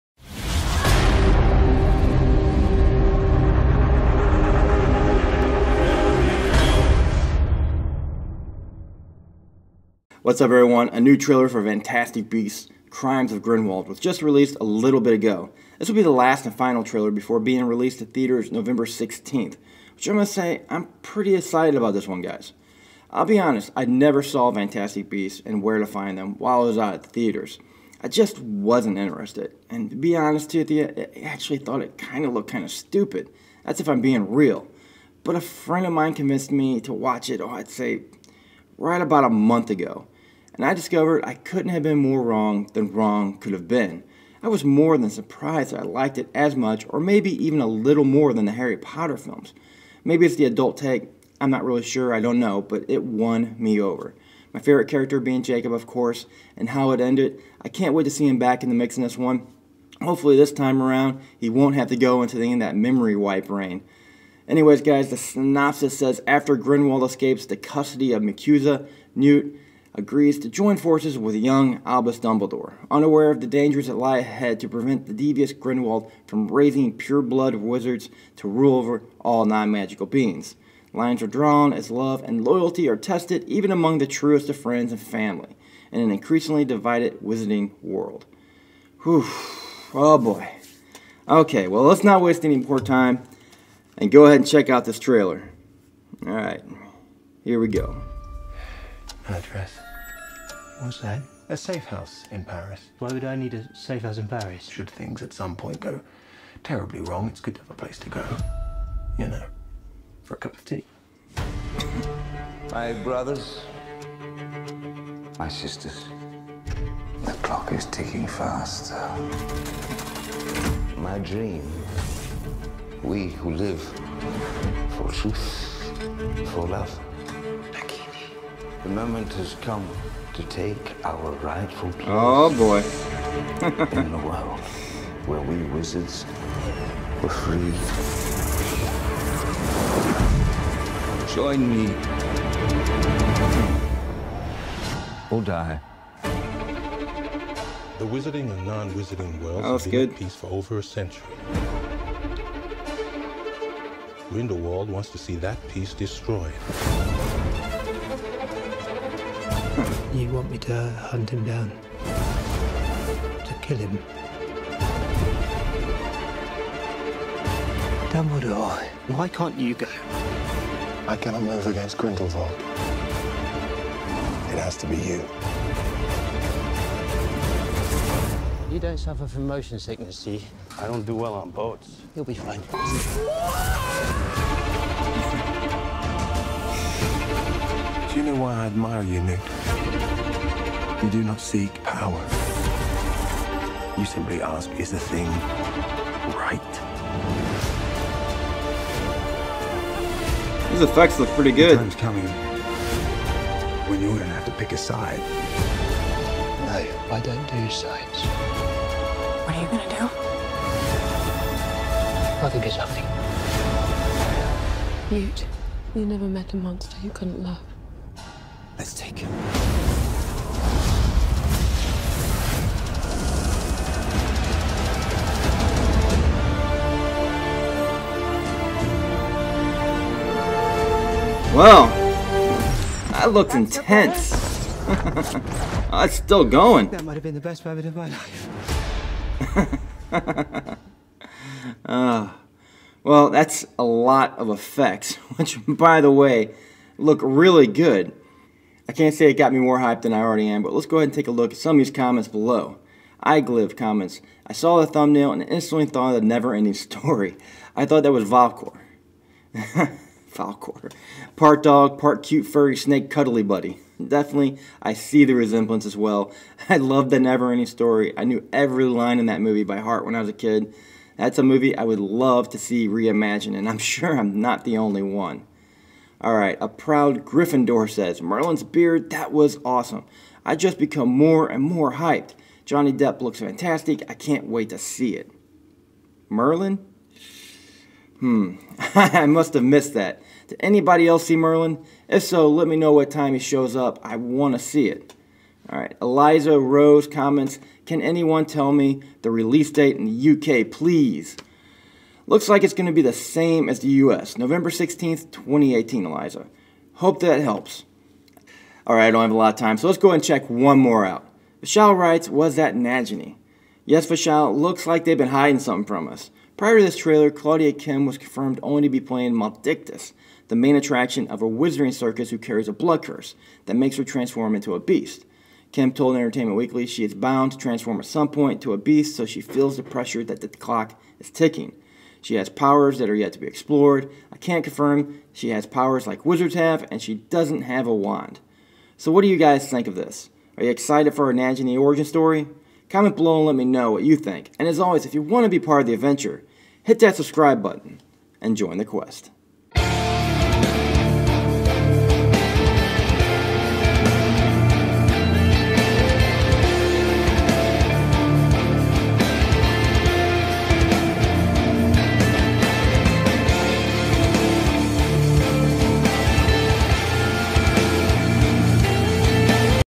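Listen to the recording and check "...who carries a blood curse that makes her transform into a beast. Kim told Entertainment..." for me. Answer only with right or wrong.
right.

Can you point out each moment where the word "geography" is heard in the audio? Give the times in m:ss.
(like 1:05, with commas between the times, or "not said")
not said.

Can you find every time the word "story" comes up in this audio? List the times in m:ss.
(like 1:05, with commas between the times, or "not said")
4:16, 4:27, 5:42.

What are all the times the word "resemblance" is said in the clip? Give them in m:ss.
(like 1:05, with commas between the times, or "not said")
4:25.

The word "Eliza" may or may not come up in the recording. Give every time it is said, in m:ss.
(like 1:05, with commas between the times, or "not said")
4:56, 5:06.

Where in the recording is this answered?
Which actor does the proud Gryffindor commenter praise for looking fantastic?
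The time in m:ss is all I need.
4:42.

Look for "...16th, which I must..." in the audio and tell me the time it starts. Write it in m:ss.
0:18.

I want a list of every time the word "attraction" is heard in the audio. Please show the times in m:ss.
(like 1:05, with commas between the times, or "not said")
5:20.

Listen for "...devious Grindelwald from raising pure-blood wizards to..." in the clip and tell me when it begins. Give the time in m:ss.
1:15.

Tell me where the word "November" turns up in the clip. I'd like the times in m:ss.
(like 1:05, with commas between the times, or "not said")
0:18, 5:04.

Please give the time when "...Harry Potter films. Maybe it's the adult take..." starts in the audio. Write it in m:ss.
0:48.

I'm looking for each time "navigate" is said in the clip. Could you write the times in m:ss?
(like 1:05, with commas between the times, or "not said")
not said.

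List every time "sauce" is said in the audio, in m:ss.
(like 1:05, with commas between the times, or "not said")
not said.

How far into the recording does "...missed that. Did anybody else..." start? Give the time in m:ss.
4:49.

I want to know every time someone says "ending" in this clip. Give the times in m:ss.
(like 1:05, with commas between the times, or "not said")
4:16, 4:27.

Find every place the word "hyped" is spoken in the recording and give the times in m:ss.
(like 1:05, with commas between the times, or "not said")
4:09, 4:41.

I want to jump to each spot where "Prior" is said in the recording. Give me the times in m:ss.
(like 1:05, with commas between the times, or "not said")
5:16.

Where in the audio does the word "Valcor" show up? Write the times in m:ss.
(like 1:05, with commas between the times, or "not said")
4:18.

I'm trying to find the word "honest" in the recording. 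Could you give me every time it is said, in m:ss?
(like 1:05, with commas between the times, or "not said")
0:23, 0:30.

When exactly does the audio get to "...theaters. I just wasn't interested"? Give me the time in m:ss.
0:27.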